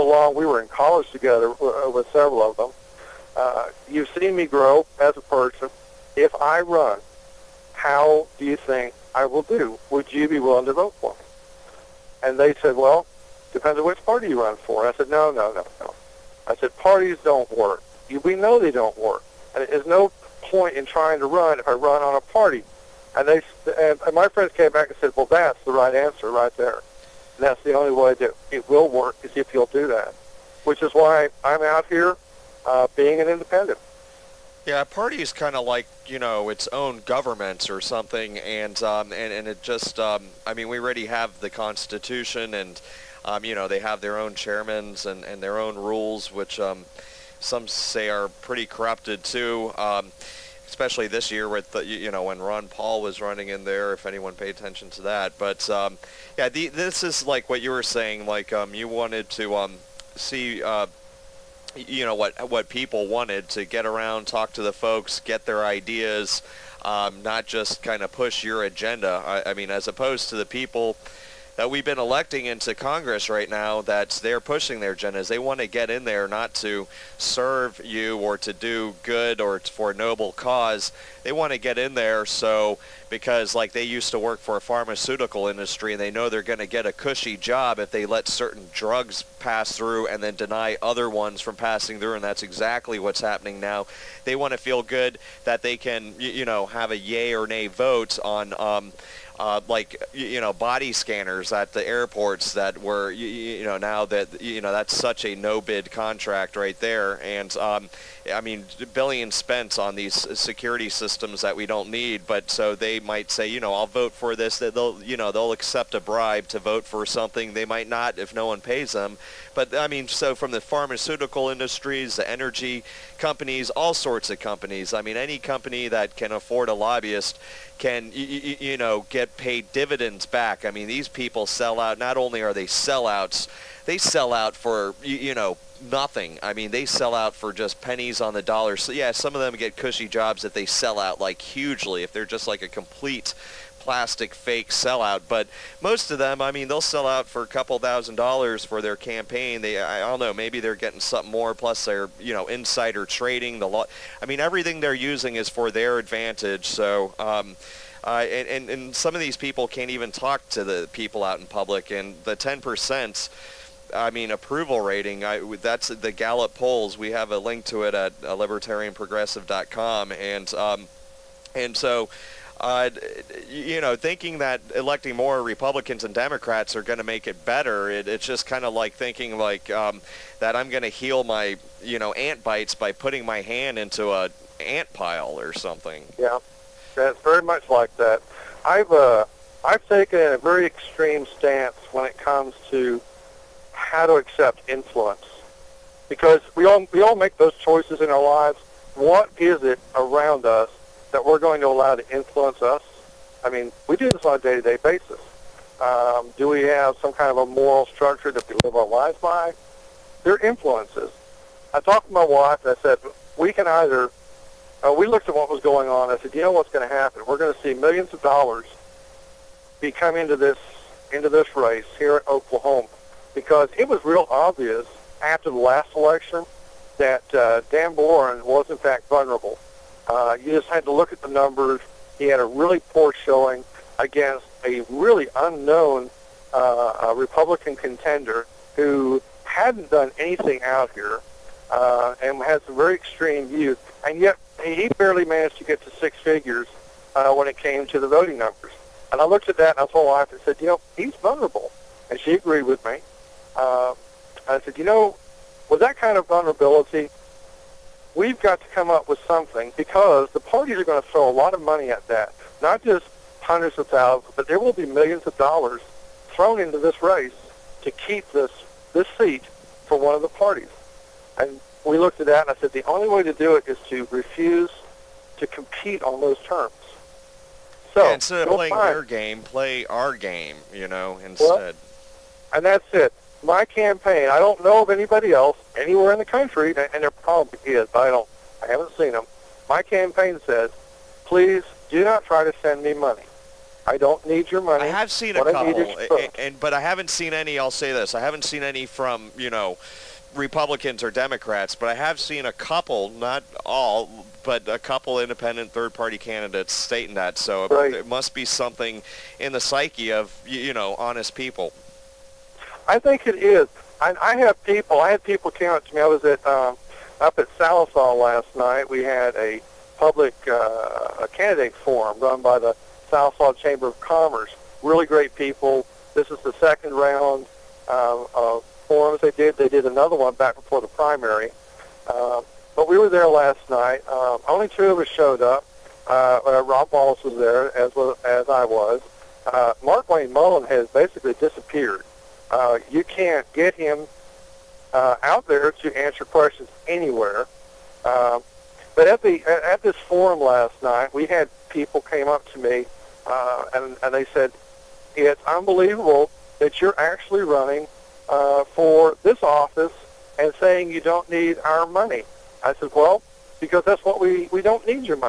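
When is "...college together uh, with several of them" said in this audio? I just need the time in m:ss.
0:00.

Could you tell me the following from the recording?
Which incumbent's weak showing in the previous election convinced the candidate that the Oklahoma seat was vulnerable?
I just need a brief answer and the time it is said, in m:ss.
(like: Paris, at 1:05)
Dan Boren, at 3:47.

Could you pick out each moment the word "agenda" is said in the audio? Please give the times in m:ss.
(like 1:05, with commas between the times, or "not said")
1:08, 1:14.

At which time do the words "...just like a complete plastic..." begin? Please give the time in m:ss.
2:22.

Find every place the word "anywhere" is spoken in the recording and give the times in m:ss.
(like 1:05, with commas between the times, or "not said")
4:45, 5:46.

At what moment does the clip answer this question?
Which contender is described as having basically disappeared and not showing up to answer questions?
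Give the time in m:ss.
5:39.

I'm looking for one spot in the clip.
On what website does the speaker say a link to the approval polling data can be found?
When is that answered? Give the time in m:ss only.
2:48.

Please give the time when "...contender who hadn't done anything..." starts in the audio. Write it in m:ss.
3:57.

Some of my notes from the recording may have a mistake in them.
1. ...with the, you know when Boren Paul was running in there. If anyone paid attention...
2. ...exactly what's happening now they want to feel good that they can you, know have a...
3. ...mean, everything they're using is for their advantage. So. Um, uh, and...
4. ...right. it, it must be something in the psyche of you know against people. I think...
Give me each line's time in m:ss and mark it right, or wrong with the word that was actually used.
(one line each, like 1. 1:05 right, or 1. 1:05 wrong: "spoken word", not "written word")
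1. 0:51 wrong: "Ron", not "Boren"
2. 1:32 right
3. 2:34 right
4. 5:07 wrong: "honest", not "against".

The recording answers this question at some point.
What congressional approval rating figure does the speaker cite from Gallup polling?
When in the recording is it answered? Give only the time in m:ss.
2:42.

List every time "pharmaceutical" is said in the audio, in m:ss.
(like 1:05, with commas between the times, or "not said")
1:24, 2:00.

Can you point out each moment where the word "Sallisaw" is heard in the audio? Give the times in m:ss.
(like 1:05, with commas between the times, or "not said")
5:17, 5:23.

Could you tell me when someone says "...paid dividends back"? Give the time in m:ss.
2:09.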